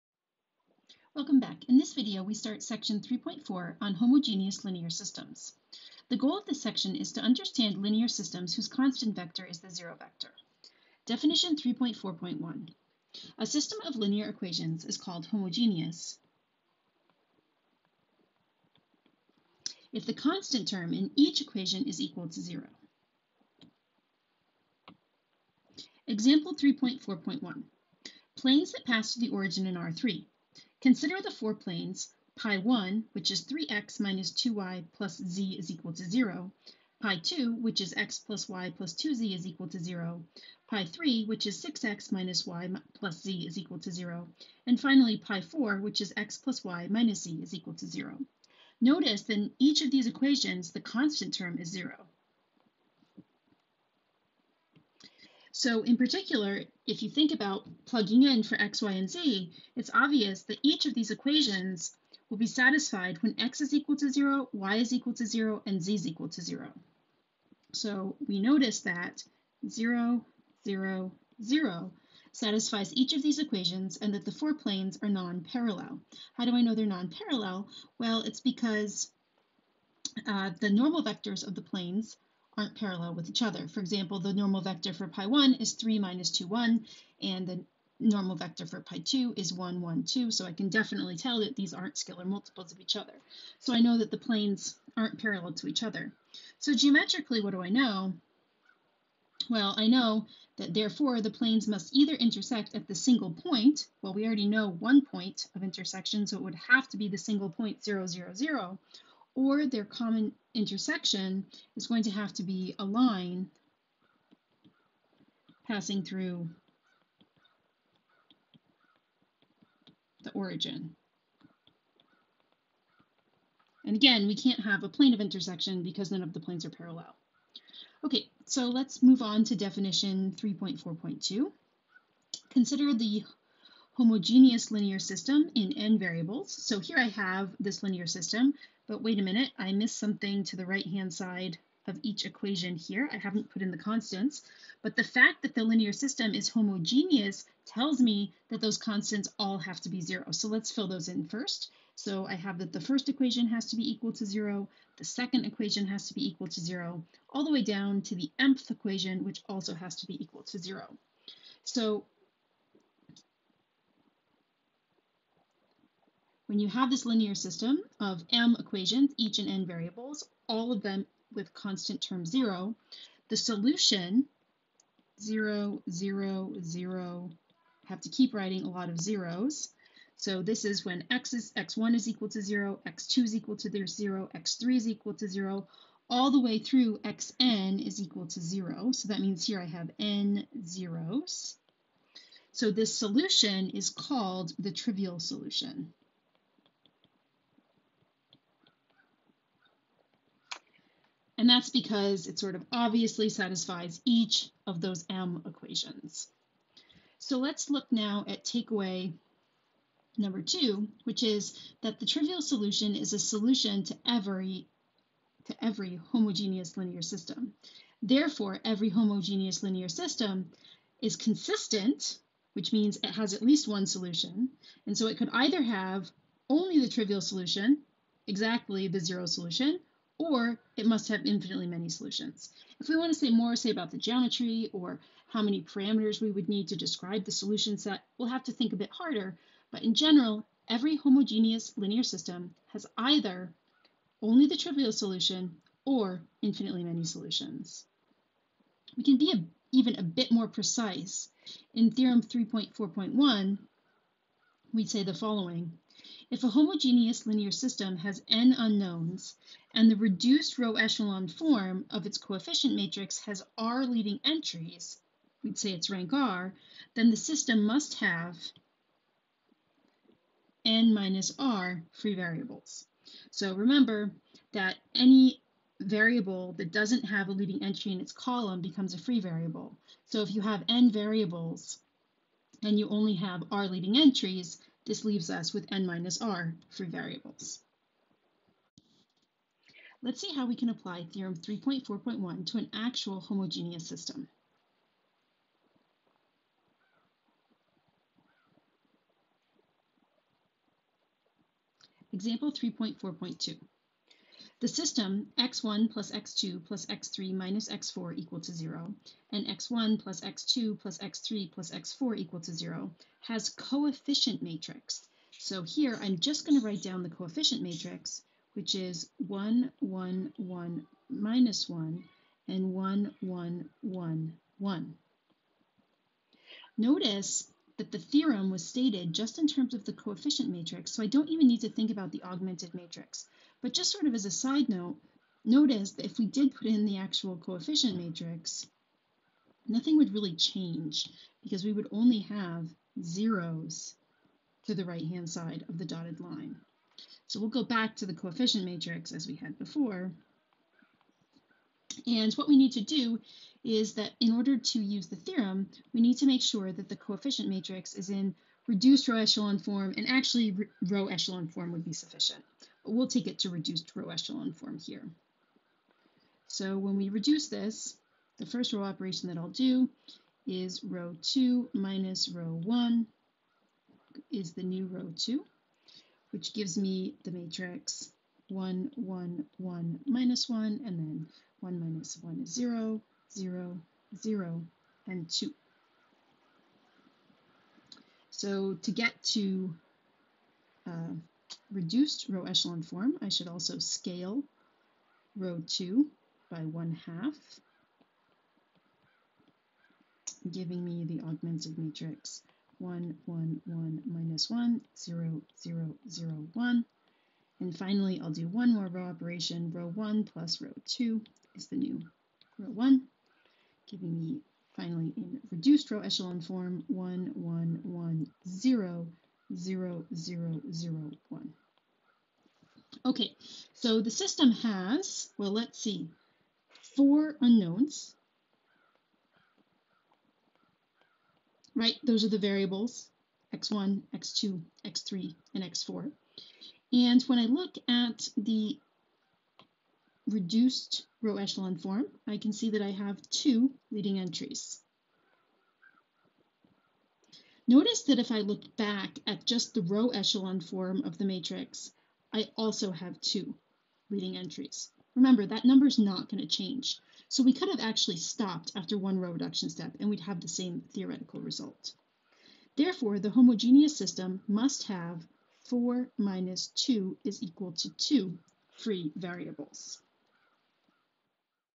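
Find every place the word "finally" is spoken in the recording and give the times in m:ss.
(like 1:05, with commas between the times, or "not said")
0:44, 6:47, 6:54.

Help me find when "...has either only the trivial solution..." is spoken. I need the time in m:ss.
4:02.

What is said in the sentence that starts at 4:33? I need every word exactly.
So remember that any variable that doesn't have a leading entry in its column becomes a free variable.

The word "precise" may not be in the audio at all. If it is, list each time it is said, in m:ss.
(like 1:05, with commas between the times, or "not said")
4:10.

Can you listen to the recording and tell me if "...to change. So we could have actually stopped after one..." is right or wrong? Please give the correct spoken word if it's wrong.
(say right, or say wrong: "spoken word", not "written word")
right.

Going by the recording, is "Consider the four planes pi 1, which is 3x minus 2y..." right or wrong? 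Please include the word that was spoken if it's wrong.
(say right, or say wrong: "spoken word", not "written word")
right.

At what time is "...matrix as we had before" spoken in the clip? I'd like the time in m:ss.
5:48.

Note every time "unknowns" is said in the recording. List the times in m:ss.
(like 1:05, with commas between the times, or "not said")
4:18, 7:07.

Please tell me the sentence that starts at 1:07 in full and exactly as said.
So we notice that 0, 0, 0 satisfies each of these equations and that the four planes are non-parallel.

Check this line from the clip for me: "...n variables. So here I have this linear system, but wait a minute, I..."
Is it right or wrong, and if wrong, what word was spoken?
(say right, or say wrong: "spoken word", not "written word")
right.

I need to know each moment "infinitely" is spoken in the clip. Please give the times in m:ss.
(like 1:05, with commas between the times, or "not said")
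3:51, 4:06.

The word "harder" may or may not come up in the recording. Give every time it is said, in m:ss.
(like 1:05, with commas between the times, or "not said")
3:58.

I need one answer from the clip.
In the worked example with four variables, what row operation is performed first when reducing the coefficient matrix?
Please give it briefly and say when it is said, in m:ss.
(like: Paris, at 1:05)
row 2 minus row 1, at 6:10.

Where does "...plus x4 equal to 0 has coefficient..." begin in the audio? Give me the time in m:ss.
5:11.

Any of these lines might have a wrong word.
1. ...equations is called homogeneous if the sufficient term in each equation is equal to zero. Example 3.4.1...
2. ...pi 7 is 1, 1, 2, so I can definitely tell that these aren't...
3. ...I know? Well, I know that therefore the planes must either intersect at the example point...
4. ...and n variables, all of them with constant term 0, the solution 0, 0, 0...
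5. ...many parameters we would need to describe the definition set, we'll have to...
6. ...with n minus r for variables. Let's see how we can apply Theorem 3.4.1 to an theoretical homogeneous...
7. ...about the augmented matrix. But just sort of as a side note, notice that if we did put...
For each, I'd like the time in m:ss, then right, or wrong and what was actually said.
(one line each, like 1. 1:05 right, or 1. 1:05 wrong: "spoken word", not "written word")
1. 0:14 wrong: "constant", not "sufficient"
2. 1:28 wrong: "2", not "7"
3. 1:37 wrong: "single", not "example"
4. 2:49 right
5. 3:55 wrong: "solution", not "definition"
6. 4:45 wrong: "actual", not "theoretical"
7. 5:31 right.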